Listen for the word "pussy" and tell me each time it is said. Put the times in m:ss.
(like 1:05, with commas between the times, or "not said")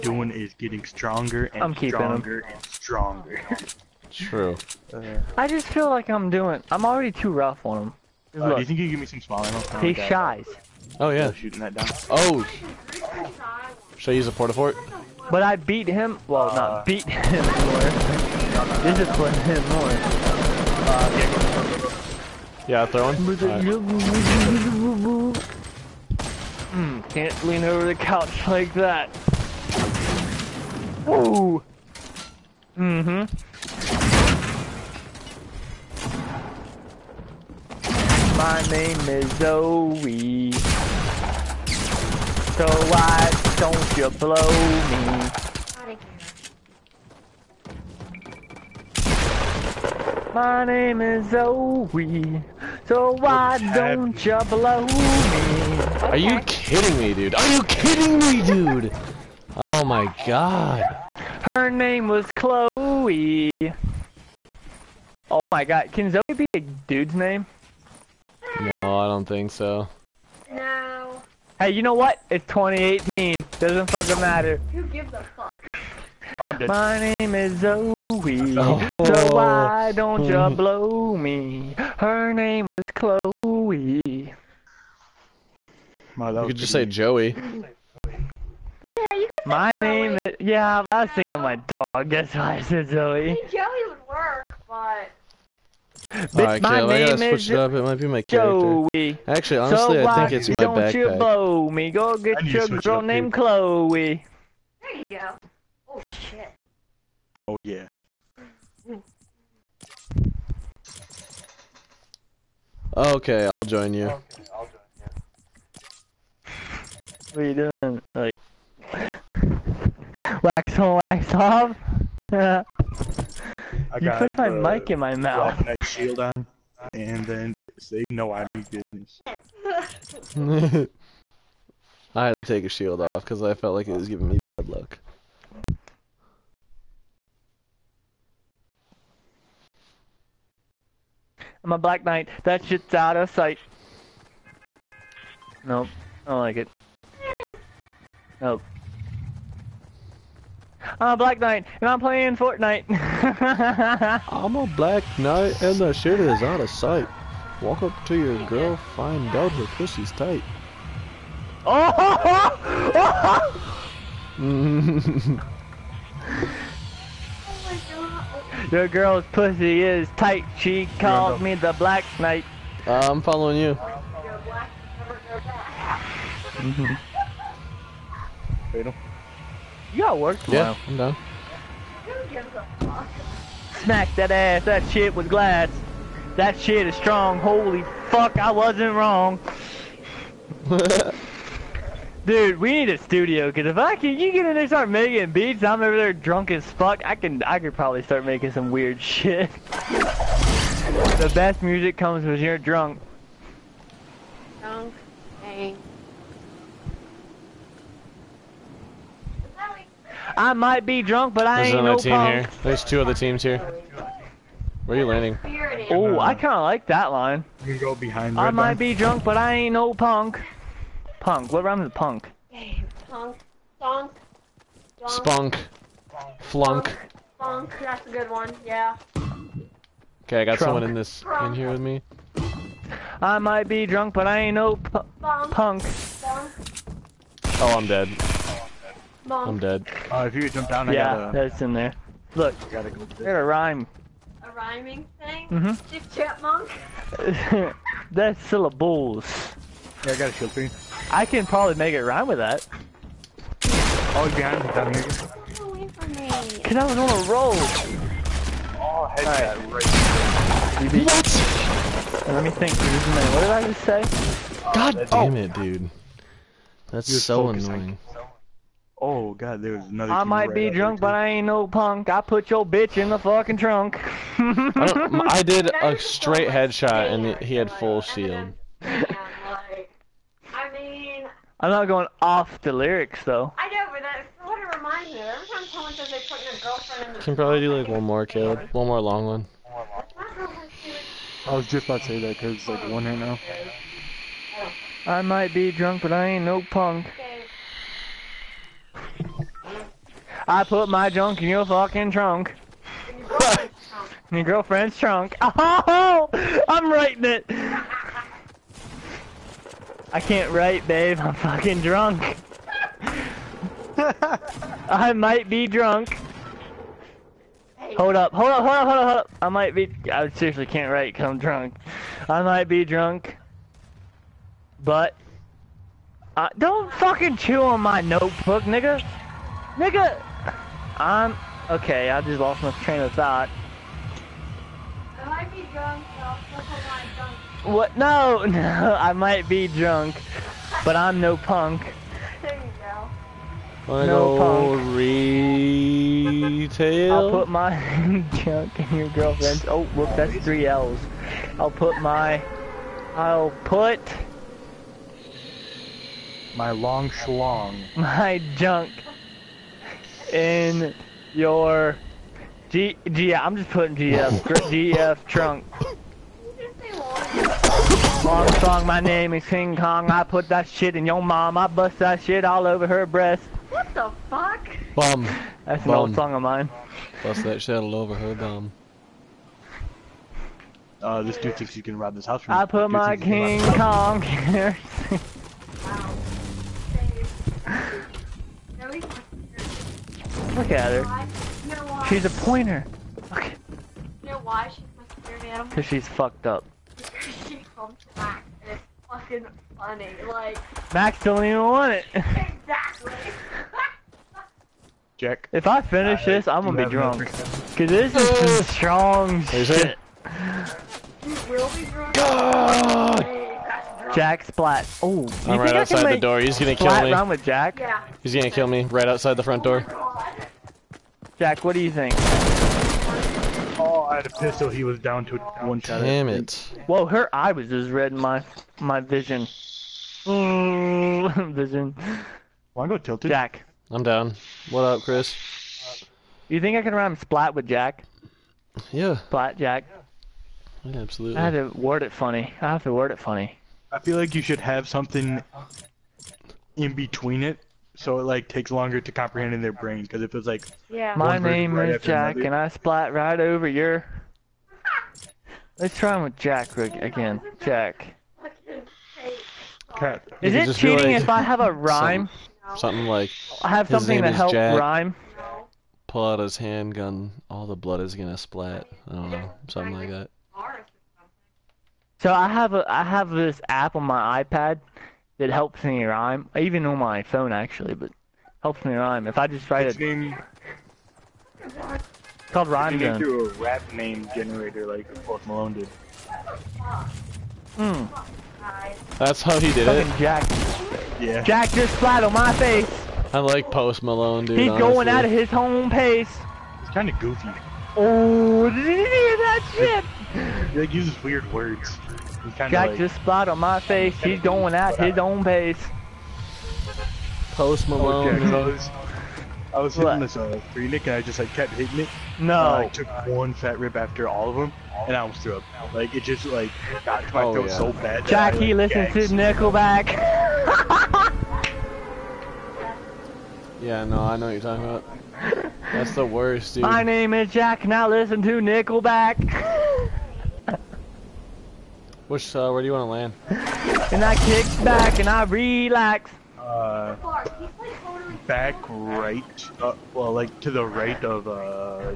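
2:39, 2:49.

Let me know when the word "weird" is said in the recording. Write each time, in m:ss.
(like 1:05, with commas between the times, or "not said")
3:18, 8:21.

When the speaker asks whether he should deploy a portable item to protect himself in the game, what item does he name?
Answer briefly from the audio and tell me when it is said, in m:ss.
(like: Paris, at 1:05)
Porta fort, at 0:14.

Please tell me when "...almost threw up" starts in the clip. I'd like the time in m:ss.
8:35.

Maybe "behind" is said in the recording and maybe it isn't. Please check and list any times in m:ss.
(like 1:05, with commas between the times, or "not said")
3:37, 4:14.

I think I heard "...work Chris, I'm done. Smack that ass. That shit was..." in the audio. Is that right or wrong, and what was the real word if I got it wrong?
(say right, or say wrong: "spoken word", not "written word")
wrong: "Yeah", not "Chris".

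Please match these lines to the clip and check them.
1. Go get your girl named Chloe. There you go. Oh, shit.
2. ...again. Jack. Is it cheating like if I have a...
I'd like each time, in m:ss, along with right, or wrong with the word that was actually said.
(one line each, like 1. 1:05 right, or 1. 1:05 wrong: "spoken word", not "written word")
1. 1:41 right
2. 7:36 right.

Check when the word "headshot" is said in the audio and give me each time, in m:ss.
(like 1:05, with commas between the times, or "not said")
4:19, 4:36.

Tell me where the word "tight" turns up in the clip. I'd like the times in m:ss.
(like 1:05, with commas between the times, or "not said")
2:40, 2:50.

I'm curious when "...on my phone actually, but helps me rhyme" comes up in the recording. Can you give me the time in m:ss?
7:56.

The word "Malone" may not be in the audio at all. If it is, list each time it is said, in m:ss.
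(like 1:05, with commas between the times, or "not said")
8:05, 8:14, 8:27.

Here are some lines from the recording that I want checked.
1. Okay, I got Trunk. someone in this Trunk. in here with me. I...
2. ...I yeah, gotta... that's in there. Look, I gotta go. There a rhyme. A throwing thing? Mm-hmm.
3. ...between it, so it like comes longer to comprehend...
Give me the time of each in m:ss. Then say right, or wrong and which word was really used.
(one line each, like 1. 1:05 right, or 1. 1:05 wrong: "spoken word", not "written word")
1. 3:50 right
2. 4:00 wrong: "rhyming", not "throwing"
3. 7:26 wrong: "takes", not "comes".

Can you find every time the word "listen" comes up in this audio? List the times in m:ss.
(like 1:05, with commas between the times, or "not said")
8:39, 8:48.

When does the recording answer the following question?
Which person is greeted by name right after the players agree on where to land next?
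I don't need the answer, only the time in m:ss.
7:15.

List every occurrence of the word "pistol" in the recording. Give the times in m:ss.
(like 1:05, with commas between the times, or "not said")
7:04.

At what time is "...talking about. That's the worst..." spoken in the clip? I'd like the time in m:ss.
8:44.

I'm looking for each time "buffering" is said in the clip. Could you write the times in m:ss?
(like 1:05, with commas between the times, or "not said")
not said.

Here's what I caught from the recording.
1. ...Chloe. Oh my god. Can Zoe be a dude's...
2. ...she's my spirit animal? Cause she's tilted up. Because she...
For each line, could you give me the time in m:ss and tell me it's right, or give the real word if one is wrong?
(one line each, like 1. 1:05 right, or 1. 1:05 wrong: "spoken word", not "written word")
1. 1:02 right
2. 6:34 wrong: "fucked", not "tilted".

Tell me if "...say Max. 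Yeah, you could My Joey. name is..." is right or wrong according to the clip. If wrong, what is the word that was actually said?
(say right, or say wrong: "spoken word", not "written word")
wrong: "Joey", not "Max".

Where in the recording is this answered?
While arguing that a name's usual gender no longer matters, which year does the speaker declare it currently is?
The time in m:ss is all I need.
1:12.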